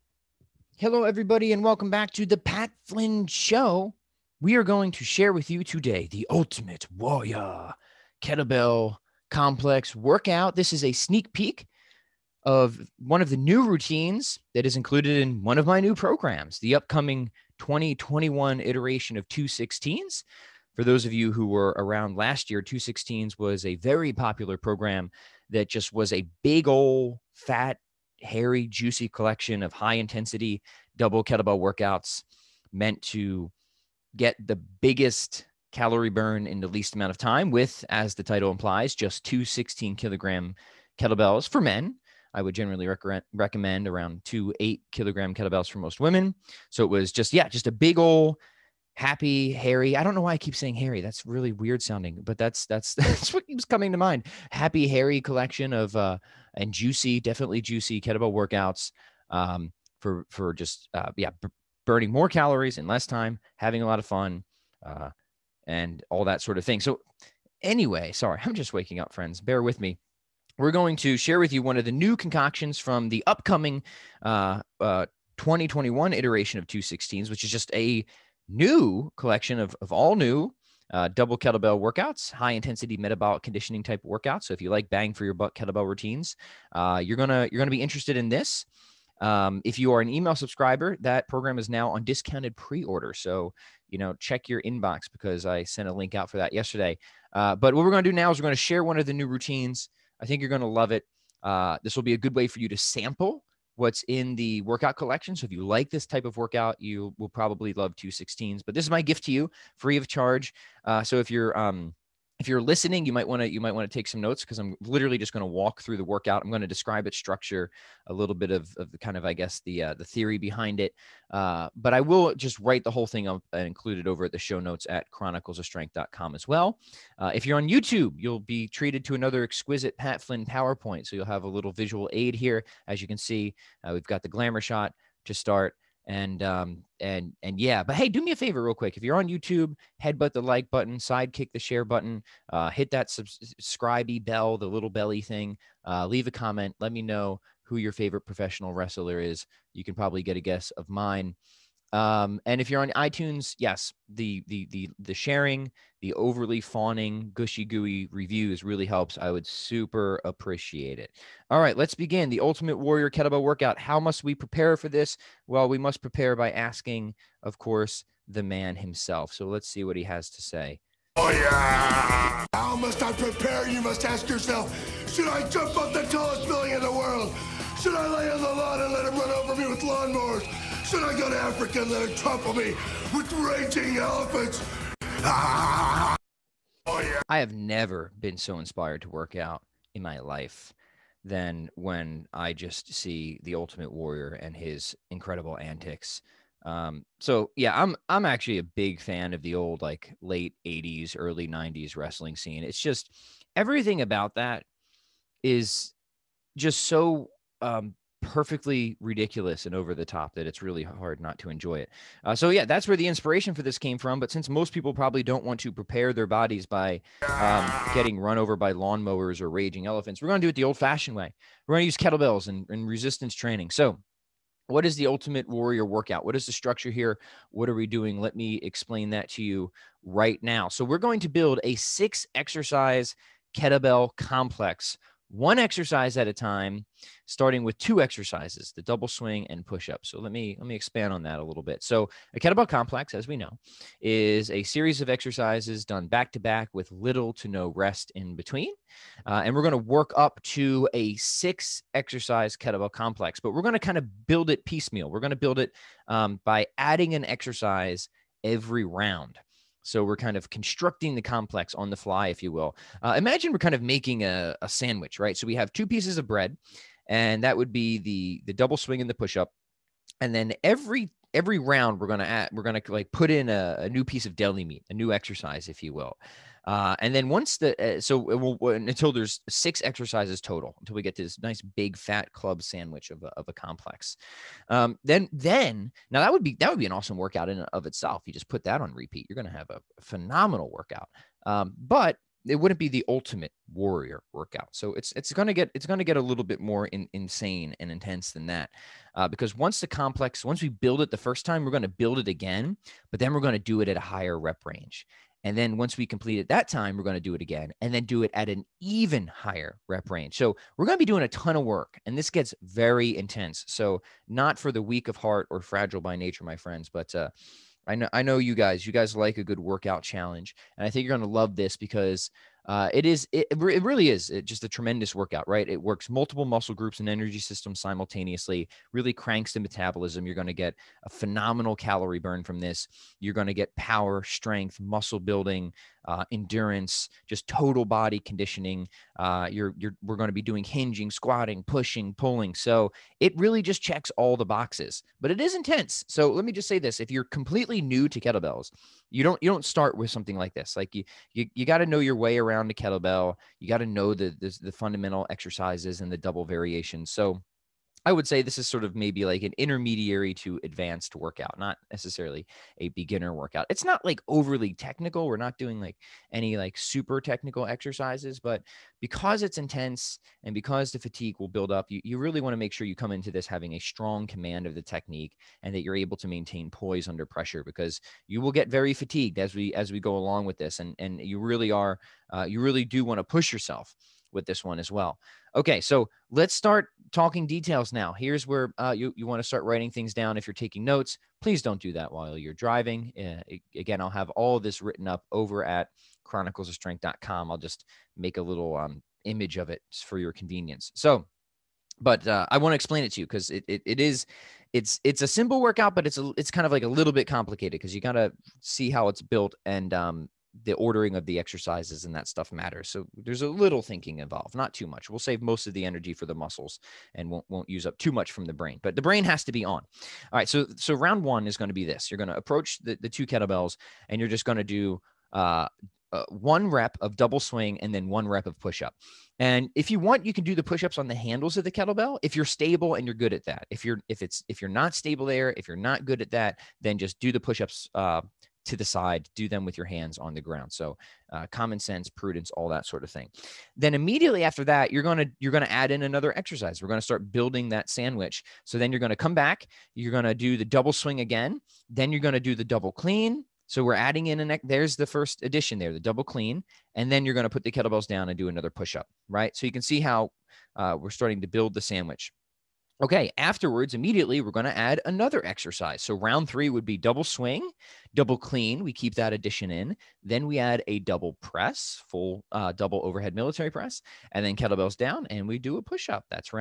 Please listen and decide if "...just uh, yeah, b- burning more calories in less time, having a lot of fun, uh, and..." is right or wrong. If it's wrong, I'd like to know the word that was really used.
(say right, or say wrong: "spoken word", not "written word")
right.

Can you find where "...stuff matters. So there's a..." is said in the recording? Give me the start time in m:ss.
6:52.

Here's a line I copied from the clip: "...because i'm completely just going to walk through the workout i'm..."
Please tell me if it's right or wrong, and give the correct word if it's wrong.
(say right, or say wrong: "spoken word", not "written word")
wrong: "literally", not "completely".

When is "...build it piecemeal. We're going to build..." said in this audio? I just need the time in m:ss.
4:14.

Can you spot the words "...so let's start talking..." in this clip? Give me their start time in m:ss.
6:25.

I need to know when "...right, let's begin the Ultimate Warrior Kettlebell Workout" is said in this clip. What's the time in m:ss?
2:41.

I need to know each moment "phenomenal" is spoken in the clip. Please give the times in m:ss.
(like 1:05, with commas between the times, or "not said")
4:50, 5:31.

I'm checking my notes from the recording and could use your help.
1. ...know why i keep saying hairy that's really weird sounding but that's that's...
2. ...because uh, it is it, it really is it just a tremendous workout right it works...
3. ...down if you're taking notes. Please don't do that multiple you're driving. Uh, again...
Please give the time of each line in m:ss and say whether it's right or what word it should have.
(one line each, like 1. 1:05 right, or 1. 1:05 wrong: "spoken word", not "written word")
1. 0:50 right
2. 5:21 right
3. 6:30 wrong: "while", not "multiple".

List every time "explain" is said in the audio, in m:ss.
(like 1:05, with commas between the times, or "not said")
3:48, 6:42.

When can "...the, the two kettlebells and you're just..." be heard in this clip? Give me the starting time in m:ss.
7:02.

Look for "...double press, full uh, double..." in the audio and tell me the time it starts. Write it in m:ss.
7:50.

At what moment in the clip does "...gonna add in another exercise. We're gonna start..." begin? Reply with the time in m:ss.
7:25.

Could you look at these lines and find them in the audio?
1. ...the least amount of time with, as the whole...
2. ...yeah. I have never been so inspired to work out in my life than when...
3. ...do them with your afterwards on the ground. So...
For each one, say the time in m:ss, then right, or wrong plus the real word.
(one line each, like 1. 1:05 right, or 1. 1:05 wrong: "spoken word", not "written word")
1. 0:36 wrong: "title", not "whole"
2. 3:06 right
3. 7:19 wrong: "hands", not "afterwards".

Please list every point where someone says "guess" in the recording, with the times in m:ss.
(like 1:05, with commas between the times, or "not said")
1:59, 2:30.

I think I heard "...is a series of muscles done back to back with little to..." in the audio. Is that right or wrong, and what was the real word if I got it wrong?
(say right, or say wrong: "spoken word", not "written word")
wrong: "exercises", not "muscles".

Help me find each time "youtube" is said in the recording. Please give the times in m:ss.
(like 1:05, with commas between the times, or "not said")
2:07, 2:19.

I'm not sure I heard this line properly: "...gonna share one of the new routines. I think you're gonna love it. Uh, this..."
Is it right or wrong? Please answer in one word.
right.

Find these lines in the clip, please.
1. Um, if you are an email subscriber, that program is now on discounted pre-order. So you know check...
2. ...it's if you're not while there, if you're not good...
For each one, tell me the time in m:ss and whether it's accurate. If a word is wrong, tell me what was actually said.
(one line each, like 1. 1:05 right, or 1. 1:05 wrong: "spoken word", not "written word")
1. 1:29 right
2. 7:14 wrong: "stable", not "while".